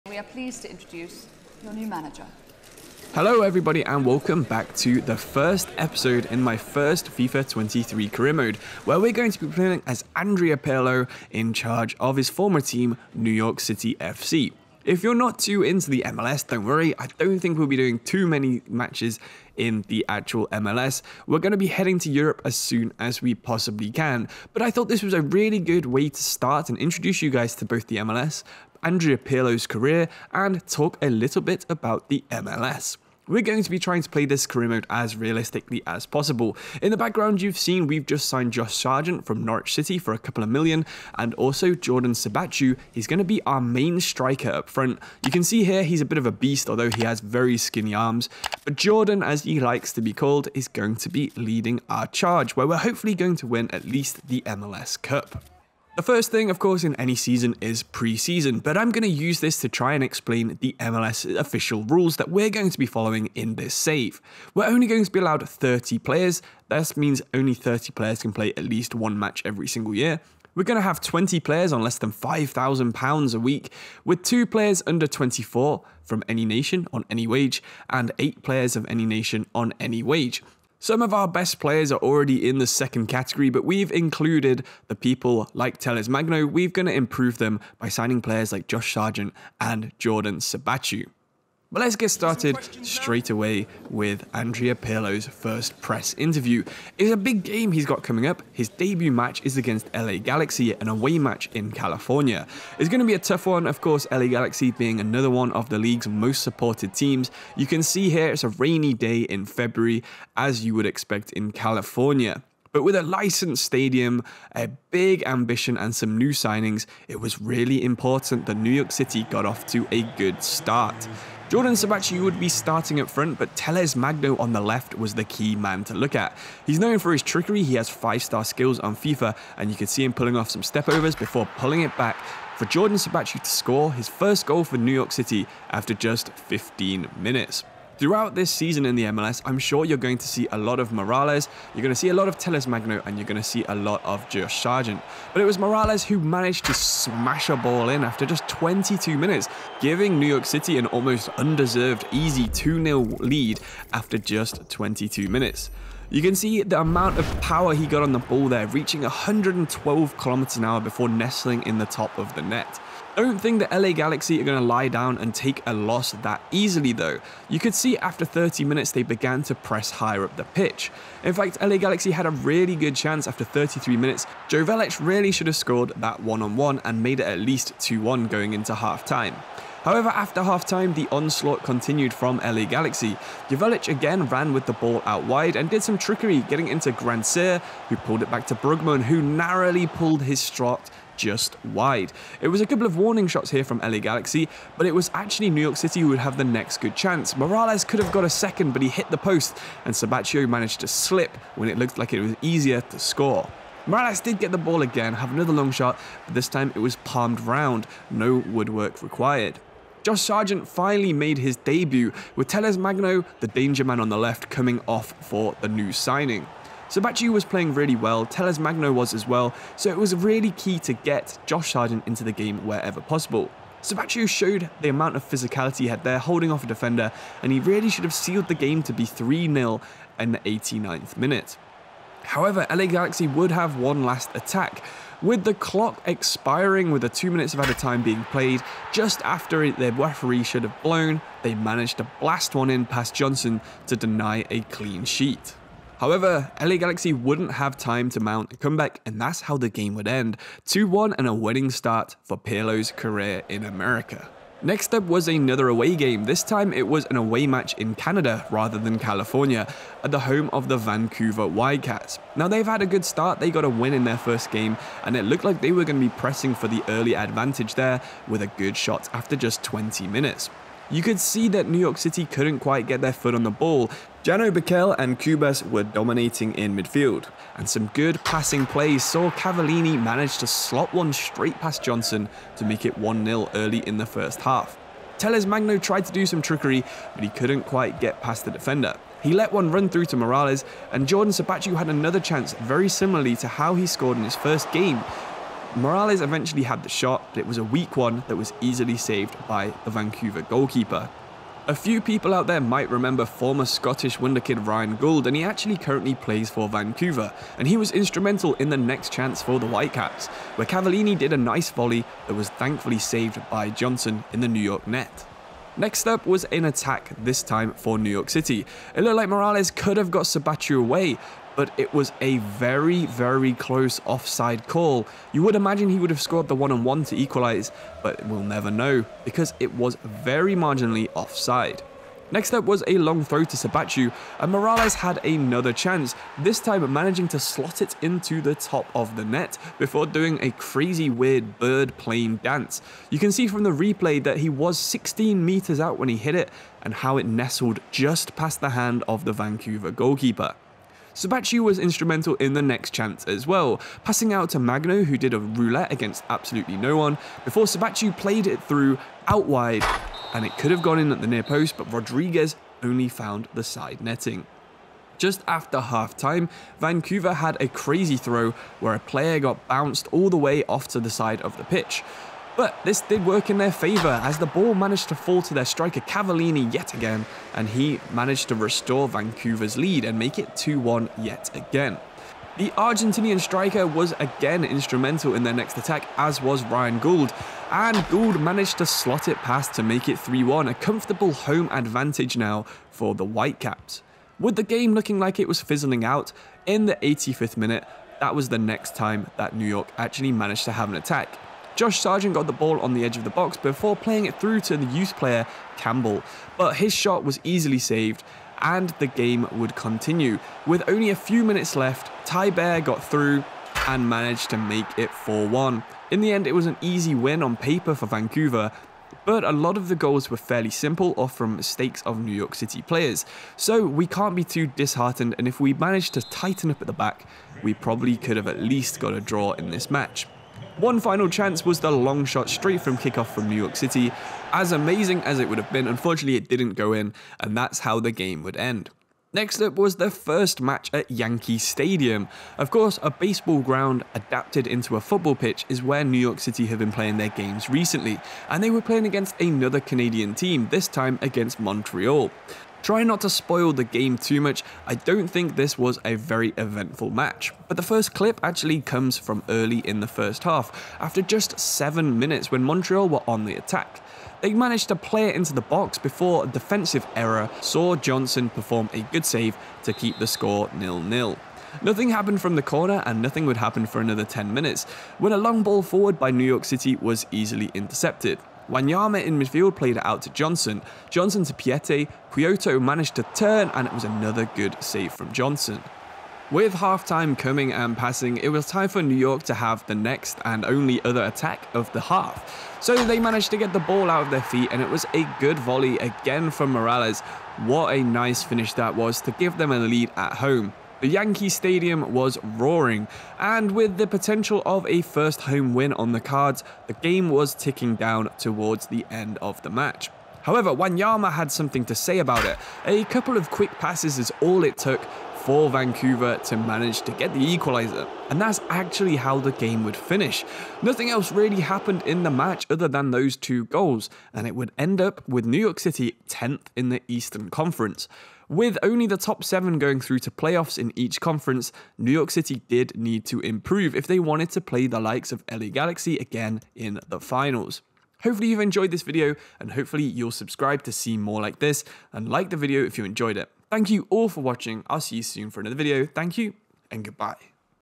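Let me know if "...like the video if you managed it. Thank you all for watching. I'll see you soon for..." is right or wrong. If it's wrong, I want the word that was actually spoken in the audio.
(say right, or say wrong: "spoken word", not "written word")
wrong: "enjoyed", not "managed".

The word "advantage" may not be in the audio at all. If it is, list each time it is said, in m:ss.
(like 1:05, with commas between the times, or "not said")
4:27, 6:31.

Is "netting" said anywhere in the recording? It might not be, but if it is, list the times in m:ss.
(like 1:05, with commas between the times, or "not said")
6:04.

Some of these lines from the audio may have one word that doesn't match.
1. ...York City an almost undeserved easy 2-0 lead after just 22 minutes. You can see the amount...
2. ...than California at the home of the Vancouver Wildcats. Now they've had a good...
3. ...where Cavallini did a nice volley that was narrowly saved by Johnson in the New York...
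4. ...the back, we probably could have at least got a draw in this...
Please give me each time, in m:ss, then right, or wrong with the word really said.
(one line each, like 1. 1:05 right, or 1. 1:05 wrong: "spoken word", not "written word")
1. 2:30 right
2. 4:18 right
3. 5:10 wrong: "thankfully", not "narrowly"
4. 7:06 right.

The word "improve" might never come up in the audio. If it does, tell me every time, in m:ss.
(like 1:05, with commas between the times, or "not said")
1:26, 8:53.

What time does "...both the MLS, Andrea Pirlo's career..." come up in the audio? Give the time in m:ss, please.
0:27.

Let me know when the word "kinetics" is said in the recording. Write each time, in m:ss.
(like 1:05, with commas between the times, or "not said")
not said.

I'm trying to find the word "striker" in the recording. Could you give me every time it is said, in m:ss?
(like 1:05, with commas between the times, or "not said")
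0:44, 6:15, 6:23.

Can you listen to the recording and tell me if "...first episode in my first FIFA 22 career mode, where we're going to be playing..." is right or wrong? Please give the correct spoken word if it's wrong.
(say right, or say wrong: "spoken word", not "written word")
wrong: "23", not "22".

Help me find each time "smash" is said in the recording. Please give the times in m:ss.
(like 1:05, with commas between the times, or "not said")
2:26.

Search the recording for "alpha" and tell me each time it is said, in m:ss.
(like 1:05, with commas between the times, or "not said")
not said.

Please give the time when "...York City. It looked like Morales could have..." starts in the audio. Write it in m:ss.
5:18.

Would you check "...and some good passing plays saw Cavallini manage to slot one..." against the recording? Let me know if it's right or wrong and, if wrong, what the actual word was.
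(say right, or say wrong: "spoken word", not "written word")
right.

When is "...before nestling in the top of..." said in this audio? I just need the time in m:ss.
2:40.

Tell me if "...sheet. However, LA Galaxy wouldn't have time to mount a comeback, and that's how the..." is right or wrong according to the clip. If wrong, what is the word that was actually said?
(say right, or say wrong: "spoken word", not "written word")
right.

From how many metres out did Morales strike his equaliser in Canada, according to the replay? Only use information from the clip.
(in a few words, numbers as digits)
16.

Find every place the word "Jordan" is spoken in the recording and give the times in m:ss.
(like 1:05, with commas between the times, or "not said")
0:41, 0:48, 1:29, 2:01, 2:12, 4:51.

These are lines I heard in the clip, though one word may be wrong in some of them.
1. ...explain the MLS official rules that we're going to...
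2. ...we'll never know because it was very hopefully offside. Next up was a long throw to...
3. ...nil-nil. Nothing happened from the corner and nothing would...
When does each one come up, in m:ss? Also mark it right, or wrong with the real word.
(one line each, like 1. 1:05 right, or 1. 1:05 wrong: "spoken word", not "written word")
1. 1:00 right
2. 5:28 wrong: "marginally", not "hopefully"
3. 7:50 right.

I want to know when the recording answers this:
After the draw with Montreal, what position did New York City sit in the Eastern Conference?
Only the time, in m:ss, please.
8:46.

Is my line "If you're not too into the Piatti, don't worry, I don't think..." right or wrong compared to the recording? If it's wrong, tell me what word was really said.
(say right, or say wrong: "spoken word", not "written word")
wrong: "MLS", not "Piatti".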